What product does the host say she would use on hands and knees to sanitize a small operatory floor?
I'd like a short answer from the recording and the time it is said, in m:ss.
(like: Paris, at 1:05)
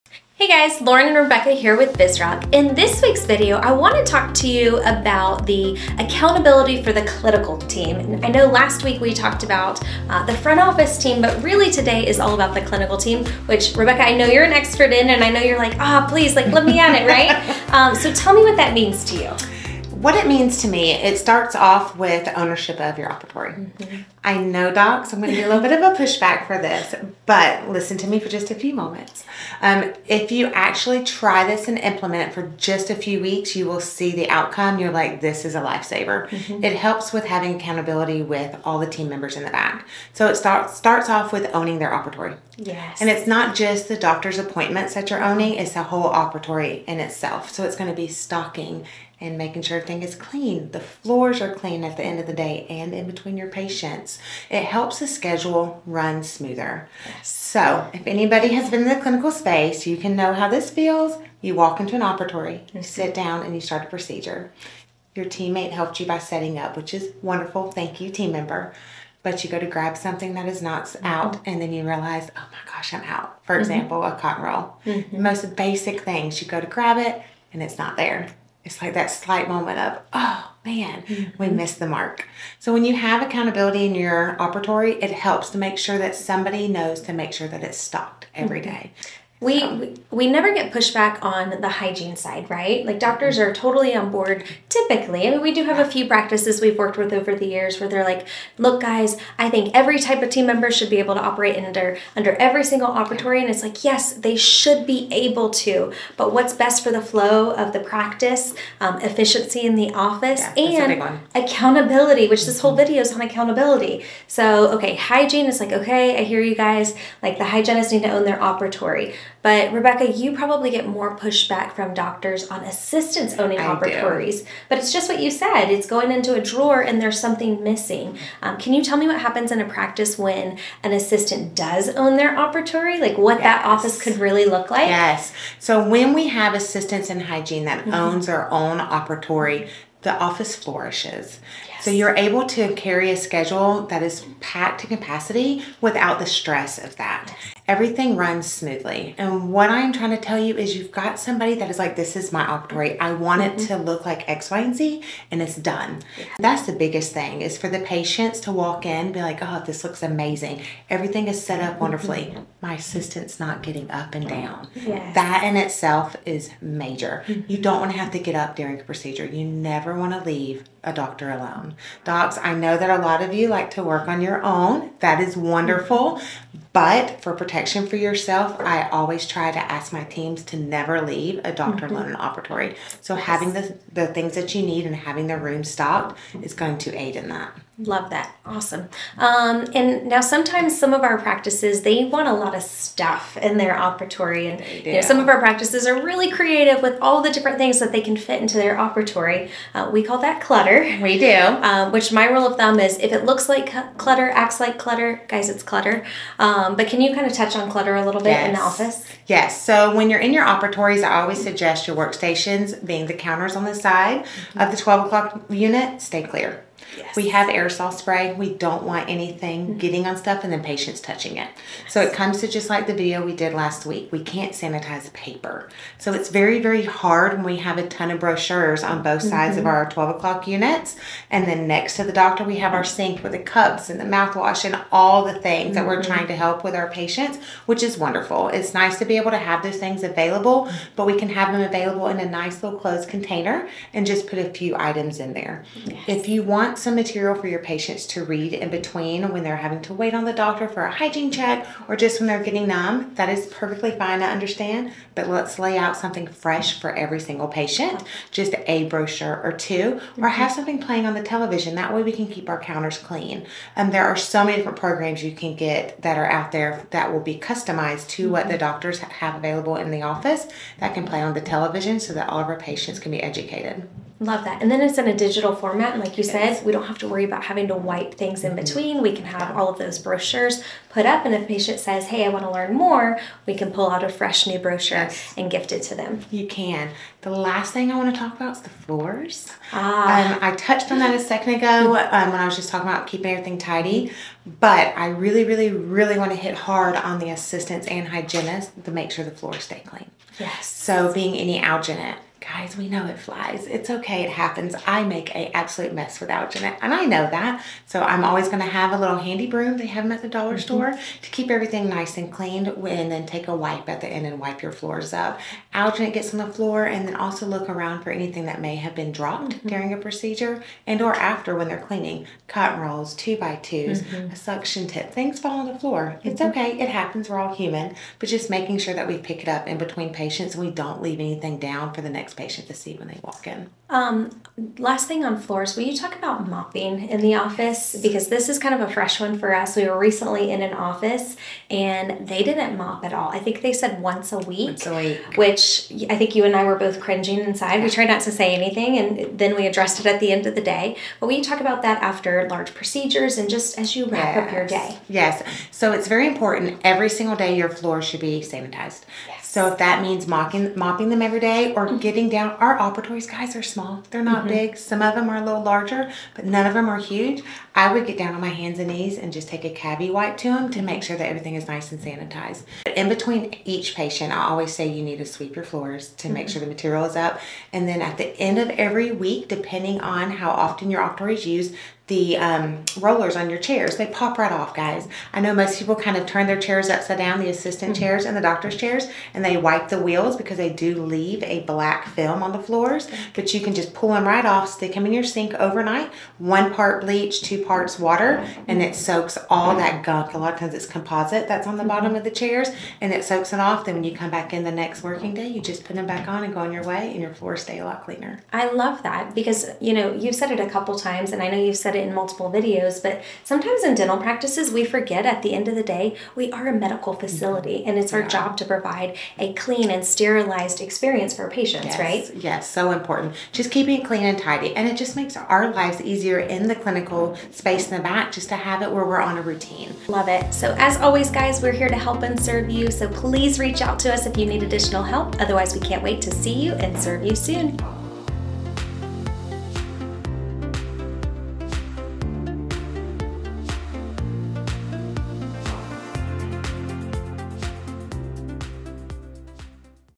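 CaviWipe, at 6:09.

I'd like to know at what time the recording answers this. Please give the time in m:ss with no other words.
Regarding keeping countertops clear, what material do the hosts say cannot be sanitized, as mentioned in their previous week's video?
3:45.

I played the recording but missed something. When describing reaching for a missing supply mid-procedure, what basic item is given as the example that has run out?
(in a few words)
cotton roll.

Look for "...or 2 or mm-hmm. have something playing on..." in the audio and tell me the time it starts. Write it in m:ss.
4:19.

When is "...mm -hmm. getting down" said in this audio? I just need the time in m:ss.
6:01.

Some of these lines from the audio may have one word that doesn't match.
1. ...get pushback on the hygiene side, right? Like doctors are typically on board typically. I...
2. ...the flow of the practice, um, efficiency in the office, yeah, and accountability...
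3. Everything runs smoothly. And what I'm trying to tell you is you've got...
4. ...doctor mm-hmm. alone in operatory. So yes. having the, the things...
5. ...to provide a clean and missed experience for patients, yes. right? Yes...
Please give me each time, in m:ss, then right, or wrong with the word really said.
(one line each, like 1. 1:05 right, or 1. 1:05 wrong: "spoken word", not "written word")
1. 1:30 wrong: "totally", not "typically"
2. 1:46 right
3. 2:27 right
4. 3:01 right
5. 6:58 wrong: "sterilized", not "missed".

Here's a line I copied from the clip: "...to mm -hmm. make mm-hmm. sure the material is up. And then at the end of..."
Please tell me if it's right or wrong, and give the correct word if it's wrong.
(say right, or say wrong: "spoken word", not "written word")
right.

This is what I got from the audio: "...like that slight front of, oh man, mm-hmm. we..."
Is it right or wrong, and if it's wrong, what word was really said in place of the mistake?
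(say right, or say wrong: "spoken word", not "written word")
wrong: "moment", not "front".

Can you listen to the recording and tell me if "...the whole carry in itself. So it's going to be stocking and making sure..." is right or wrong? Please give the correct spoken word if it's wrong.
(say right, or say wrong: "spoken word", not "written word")
wrong: "operatory", not "carry".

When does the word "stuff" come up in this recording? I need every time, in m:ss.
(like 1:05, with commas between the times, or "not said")
3:12, 3:40.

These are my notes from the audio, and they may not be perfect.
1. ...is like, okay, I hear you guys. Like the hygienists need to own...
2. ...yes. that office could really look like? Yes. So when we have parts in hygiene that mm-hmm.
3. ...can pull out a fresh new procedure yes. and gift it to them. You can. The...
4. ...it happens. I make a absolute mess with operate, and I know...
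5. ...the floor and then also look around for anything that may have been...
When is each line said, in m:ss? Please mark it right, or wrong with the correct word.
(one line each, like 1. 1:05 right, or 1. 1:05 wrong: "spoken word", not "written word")
1. 1:55 right
2. 2:13 wrong: "assistants", not "parts"
3. 4:43 wrong: "brochure", not "procedure"
4. 5:04 wrong: "alginate", not "operate"
5. 5:16 right.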